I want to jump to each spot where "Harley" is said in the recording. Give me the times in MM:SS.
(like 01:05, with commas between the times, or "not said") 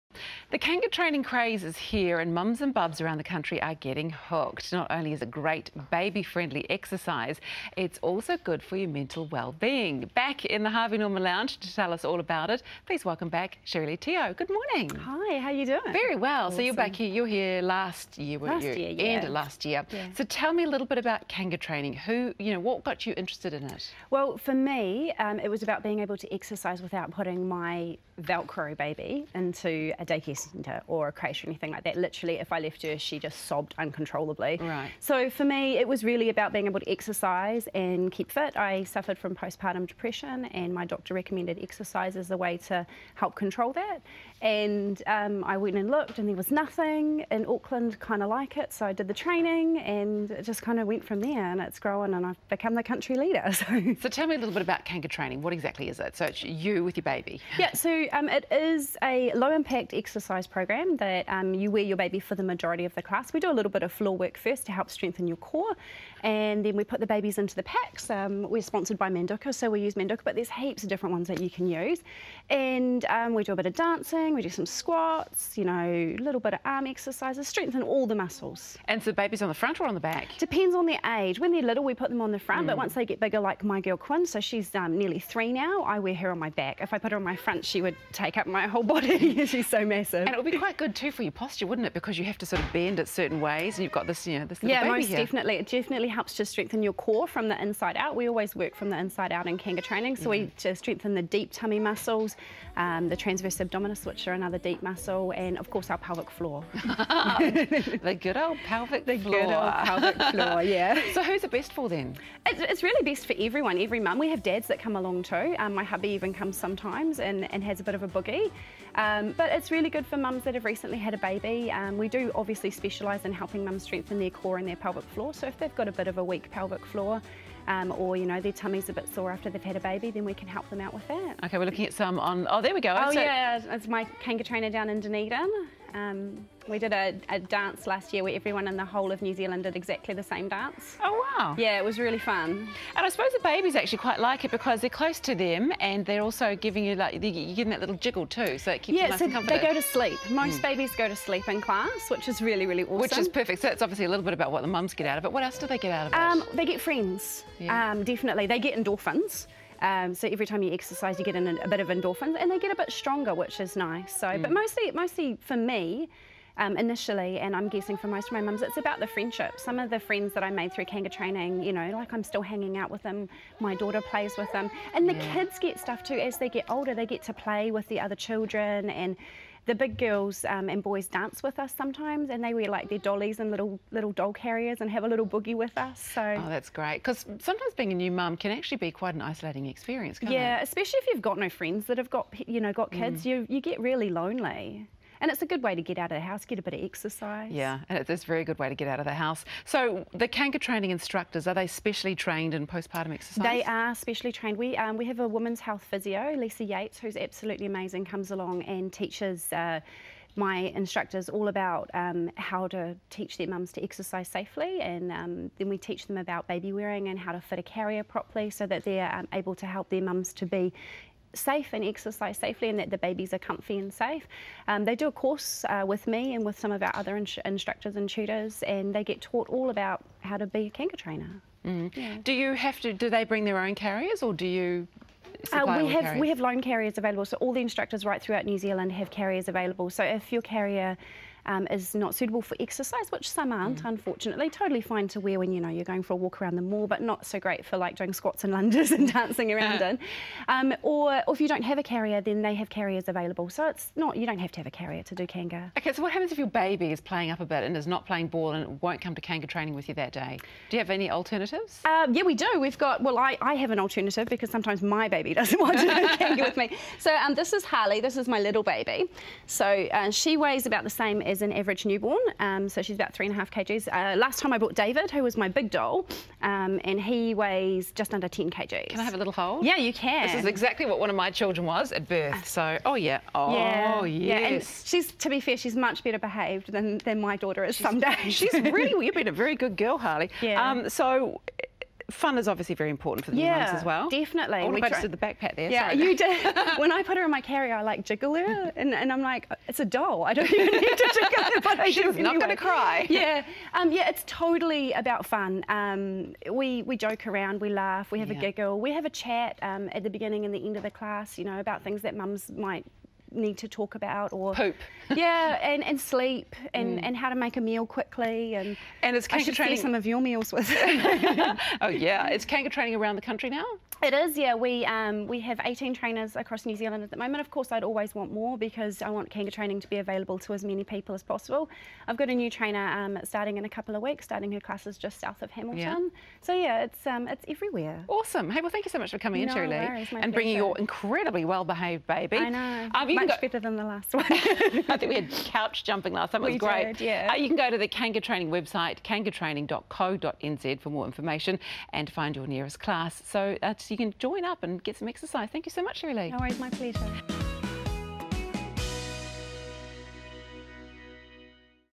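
04:27, 04:49.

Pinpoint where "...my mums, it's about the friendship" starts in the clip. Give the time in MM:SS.
02:48.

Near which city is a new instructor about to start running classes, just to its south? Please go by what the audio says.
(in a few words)
Hamilton.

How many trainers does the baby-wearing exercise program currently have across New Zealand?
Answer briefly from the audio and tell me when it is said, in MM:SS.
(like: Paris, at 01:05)
18, at 05:25.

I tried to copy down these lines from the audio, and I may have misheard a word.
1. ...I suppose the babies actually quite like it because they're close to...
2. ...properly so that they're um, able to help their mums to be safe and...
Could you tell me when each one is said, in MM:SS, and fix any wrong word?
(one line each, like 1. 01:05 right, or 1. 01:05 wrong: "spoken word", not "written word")
1. 02:23 right
2. 03:38 right.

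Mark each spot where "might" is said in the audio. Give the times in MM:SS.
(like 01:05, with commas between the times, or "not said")
05:12.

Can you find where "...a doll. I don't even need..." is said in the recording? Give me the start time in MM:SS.
04:59.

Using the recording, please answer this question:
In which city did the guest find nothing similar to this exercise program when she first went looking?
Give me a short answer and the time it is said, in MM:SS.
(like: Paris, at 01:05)
Auckland, at 00:47.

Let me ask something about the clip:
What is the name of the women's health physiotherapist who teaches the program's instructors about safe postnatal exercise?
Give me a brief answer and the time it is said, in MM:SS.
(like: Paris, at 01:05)
Lisa Yates, at 03:26.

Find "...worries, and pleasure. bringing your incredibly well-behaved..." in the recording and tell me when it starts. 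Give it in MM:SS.
05:39.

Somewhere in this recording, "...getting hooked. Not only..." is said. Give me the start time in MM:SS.
00:03.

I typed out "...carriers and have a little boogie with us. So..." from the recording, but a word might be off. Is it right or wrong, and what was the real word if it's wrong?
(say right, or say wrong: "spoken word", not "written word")
right.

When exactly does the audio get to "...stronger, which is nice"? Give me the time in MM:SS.
02:42.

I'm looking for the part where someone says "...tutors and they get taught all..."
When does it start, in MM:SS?
03:48.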